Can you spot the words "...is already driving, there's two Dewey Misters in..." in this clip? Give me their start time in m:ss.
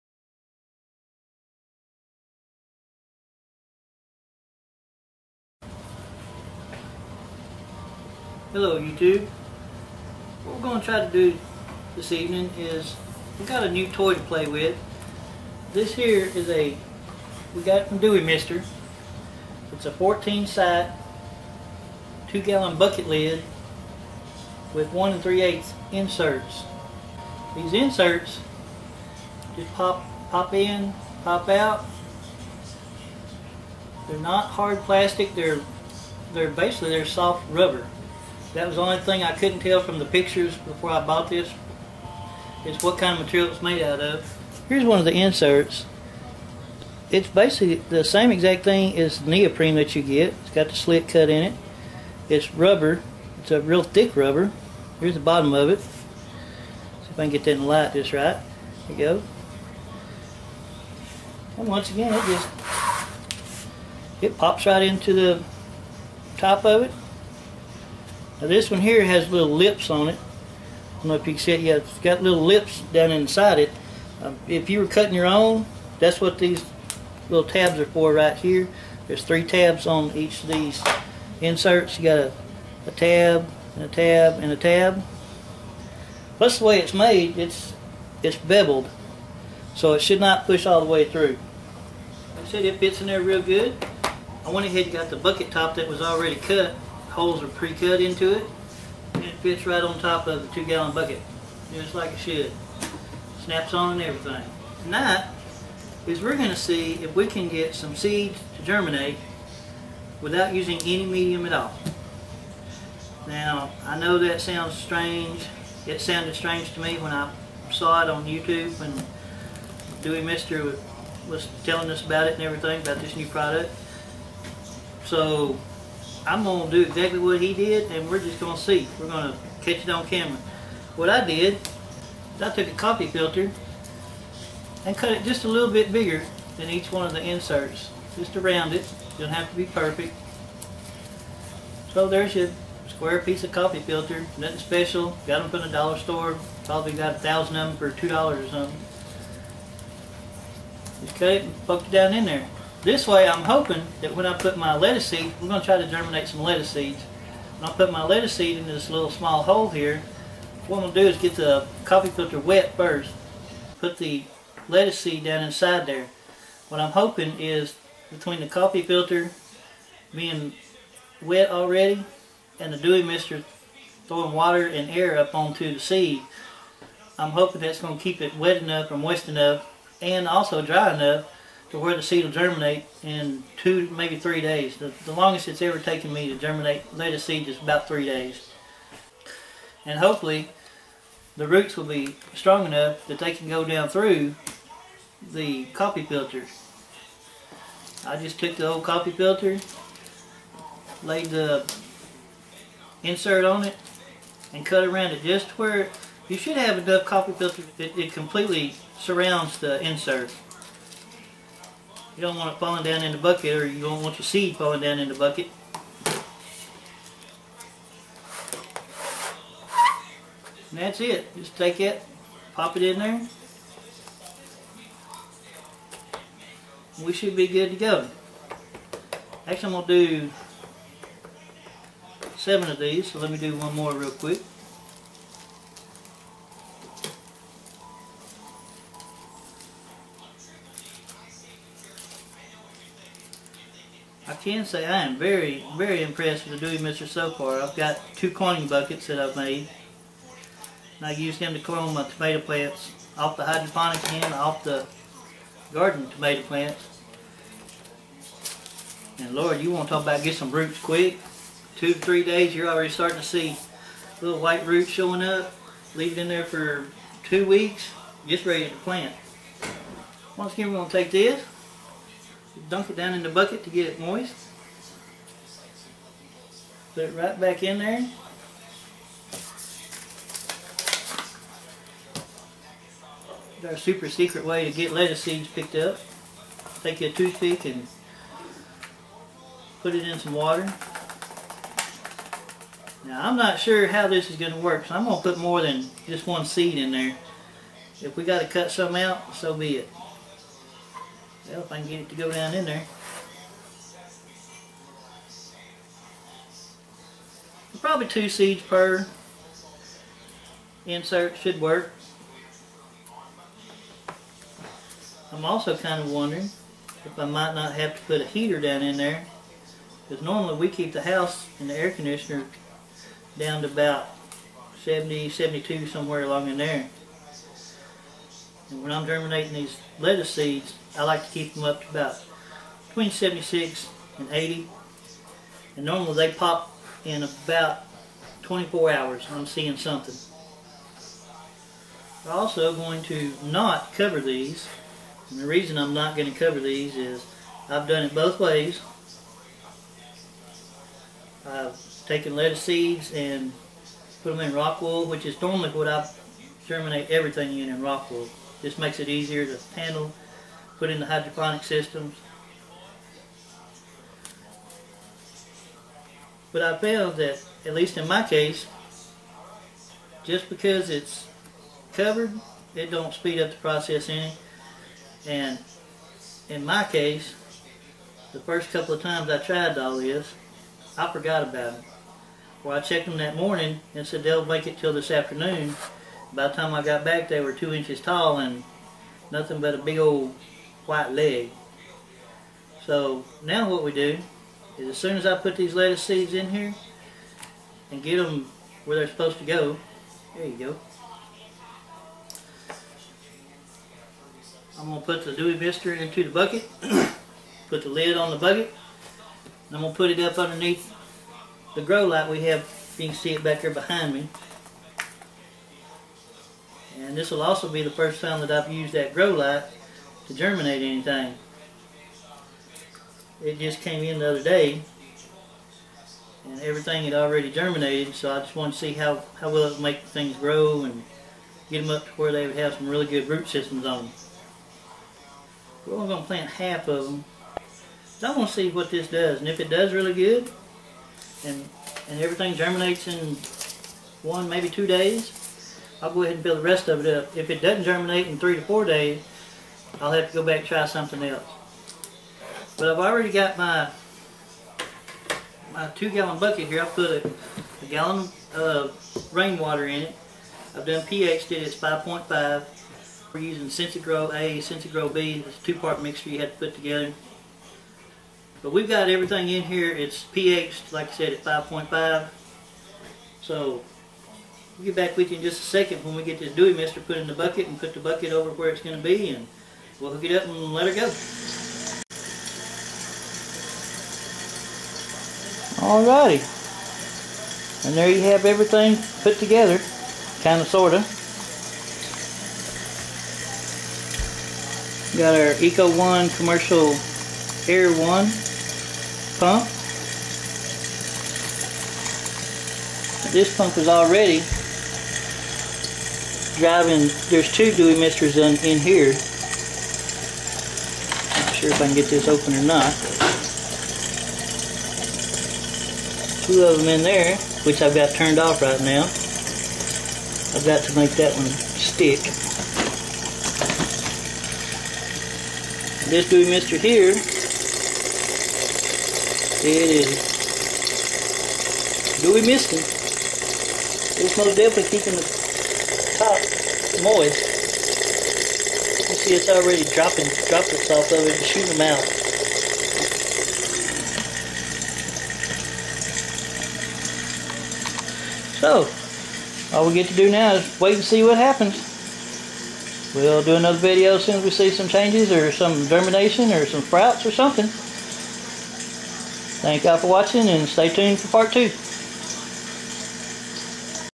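8:23.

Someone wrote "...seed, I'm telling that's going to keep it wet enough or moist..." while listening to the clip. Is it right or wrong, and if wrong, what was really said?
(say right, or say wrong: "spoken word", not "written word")
wrong: "hoping", not "telling".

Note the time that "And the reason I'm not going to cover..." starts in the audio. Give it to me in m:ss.
5:45.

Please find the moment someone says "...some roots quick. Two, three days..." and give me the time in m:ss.
4:20.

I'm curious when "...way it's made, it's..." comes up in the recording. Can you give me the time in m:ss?
1:26.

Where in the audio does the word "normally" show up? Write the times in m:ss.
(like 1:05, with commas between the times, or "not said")
5:20, 5:35, 5:55.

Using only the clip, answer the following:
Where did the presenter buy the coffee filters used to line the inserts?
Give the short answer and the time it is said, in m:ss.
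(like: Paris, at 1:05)
the dollar store, at 2:25.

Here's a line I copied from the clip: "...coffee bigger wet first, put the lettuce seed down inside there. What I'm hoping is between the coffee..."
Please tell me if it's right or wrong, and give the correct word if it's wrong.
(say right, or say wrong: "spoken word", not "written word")
wrong: "filter", not "bigger".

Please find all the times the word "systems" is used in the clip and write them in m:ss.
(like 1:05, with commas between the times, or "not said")
6:01, 7:13.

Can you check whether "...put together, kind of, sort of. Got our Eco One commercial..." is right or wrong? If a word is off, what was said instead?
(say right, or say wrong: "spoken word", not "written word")
right.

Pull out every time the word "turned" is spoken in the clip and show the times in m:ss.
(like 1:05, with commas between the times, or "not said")
8:38.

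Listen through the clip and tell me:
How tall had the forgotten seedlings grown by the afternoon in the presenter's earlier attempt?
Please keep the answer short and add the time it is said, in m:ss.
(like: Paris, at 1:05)
2 inches, at 6:27.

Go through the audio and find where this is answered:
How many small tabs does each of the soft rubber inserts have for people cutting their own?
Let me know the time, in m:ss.
1:19.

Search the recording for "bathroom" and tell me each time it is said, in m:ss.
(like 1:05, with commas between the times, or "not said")
not said.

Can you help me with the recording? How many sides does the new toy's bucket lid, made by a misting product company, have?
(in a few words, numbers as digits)
14.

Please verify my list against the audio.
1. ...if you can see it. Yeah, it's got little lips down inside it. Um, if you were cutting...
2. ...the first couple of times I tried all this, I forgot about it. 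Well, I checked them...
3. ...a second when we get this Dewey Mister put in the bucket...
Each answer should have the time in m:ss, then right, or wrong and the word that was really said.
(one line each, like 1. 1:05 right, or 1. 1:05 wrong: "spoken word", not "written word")
1. 1:11 right
2. 6:18 right
3. 7:55 right.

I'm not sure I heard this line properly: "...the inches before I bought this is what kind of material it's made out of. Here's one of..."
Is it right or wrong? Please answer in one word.
wrong.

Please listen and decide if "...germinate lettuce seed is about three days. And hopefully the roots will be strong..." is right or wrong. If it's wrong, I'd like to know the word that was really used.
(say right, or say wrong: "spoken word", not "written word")
right.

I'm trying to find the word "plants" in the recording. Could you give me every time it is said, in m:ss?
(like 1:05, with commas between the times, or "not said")
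4:12, 4:16, 4:28, 7:16.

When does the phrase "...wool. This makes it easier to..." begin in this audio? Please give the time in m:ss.
5:58.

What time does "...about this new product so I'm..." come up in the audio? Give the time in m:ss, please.
2:02.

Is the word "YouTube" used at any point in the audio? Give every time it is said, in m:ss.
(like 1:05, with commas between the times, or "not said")
0:08, 1:58.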